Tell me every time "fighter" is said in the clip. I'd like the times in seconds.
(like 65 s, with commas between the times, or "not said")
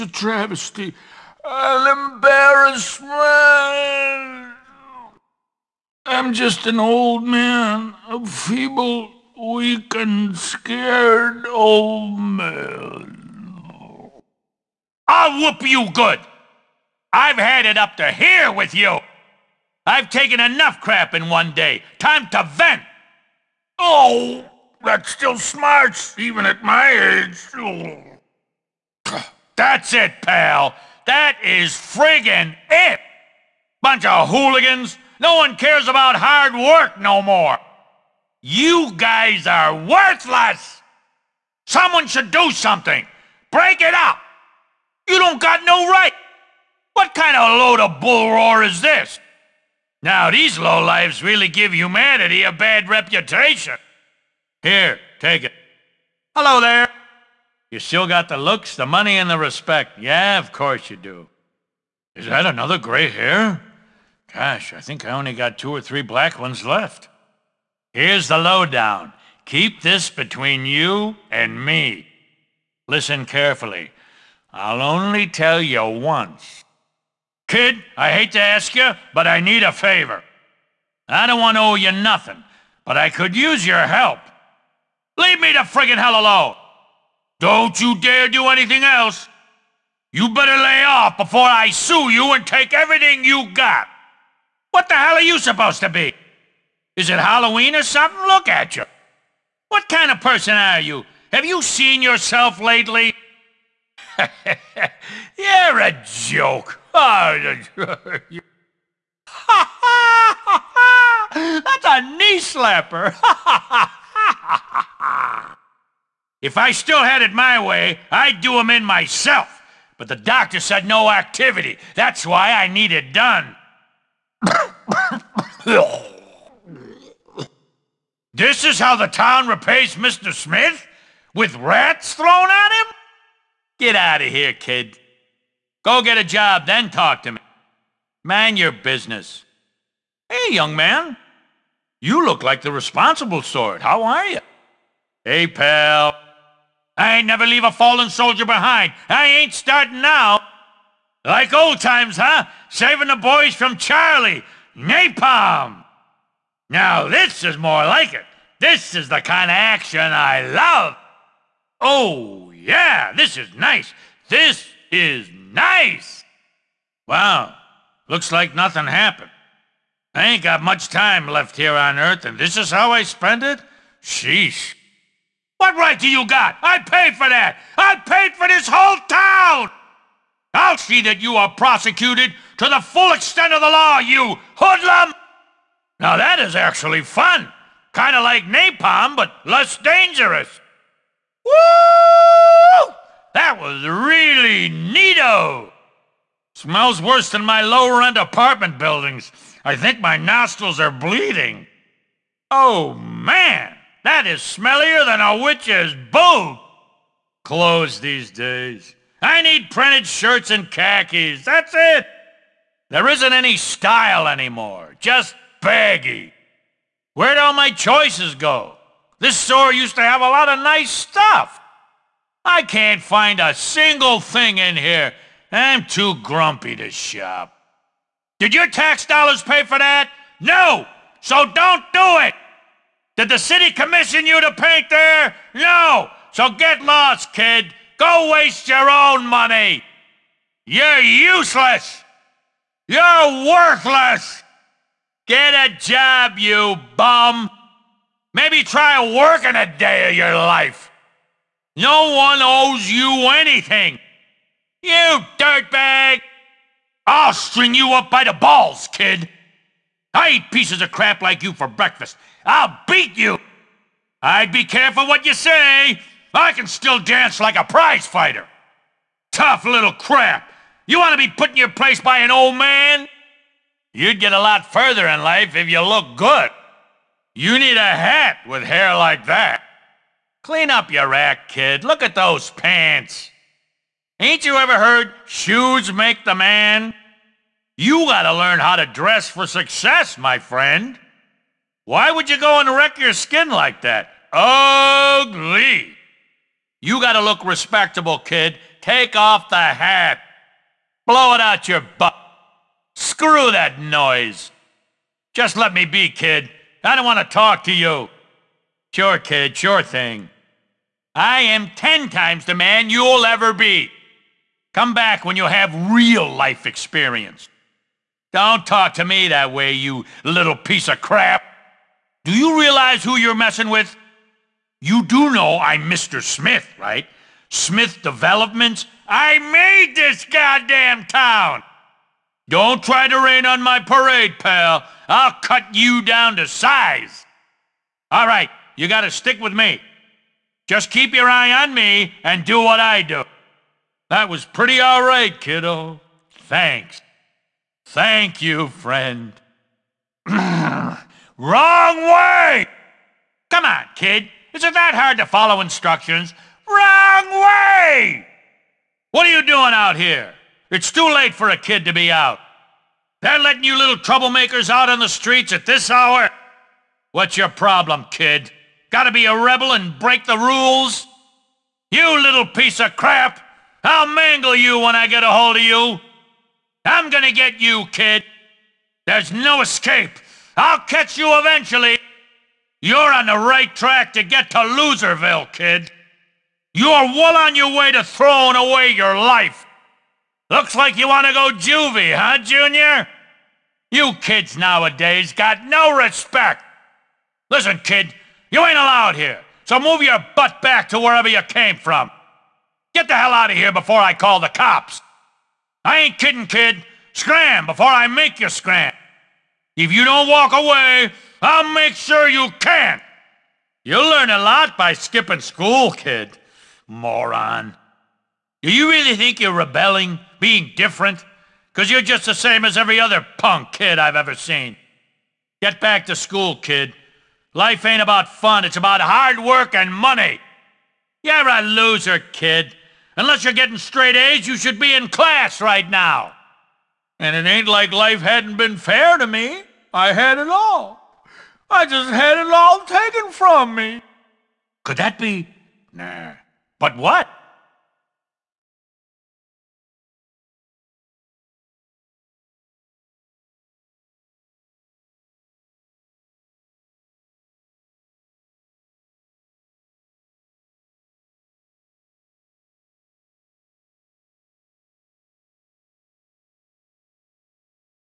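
268 s.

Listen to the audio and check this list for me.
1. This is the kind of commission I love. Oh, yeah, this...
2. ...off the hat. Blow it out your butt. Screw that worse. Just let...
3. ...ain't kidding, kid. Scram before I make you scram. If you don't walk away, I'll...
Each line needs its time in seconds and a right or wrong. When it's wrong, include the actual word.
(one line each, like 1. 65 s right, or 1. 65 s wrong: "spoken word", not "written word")
1. 158 s wrong: "action", not "commission"
2. 299 s wrong: "noise", not "worse"
3. 405 s right.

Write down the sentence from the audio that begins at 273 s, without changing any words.
You'd get a lot further in life if you look good.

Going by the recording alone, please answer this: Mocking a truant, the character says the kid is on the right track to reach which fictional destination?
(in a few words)
Loserville.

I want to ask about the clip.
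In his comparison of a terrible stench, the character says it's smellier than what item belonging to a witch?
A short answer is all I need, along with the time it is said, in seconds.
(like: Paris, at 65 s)
Boot, at 206 s.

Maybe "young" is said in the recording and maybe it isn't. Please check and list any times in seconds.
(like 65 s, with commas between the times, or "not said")
140 s.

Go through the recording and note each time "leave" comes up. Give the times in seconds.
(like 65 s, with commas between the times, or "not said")
85 s, 147 s.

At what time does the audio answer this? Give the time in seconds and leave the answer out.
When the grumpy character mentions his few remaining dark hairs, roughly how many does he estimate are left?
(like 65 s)
65 s.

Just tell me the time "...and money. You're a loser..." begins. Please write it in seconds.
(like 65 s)
429 s.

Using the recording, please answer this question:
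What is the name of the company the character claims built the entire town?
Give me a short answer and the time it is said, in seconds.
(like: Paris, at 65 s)
Smith Developments, at 327 s.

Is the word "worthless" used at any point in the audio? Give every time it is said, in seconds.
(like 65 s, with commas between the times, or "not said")
39 s, 243 s.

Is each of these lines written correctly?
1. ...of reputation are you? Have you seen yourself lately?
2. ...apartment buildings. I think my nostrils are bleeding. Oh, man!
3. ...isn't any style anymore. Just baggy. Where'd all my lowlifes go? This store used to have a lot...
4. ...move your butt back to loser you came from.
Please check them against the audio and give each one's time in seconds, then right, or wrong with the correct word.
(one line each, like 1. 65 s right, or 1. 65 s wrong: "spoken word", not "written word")
1. 100 s wrong: "person", not "reputation"
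2. 198 s right
3. 213 s wrong: "choices", not "lowlifes"
4. 399 s wrong: "wherever", not "loser".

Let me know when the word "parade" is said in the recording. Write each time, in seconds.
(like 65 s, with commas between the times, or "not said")
333 s.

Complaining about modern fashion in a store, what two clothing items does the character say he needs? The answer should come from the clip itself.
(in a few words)
Printed shirts and khakis.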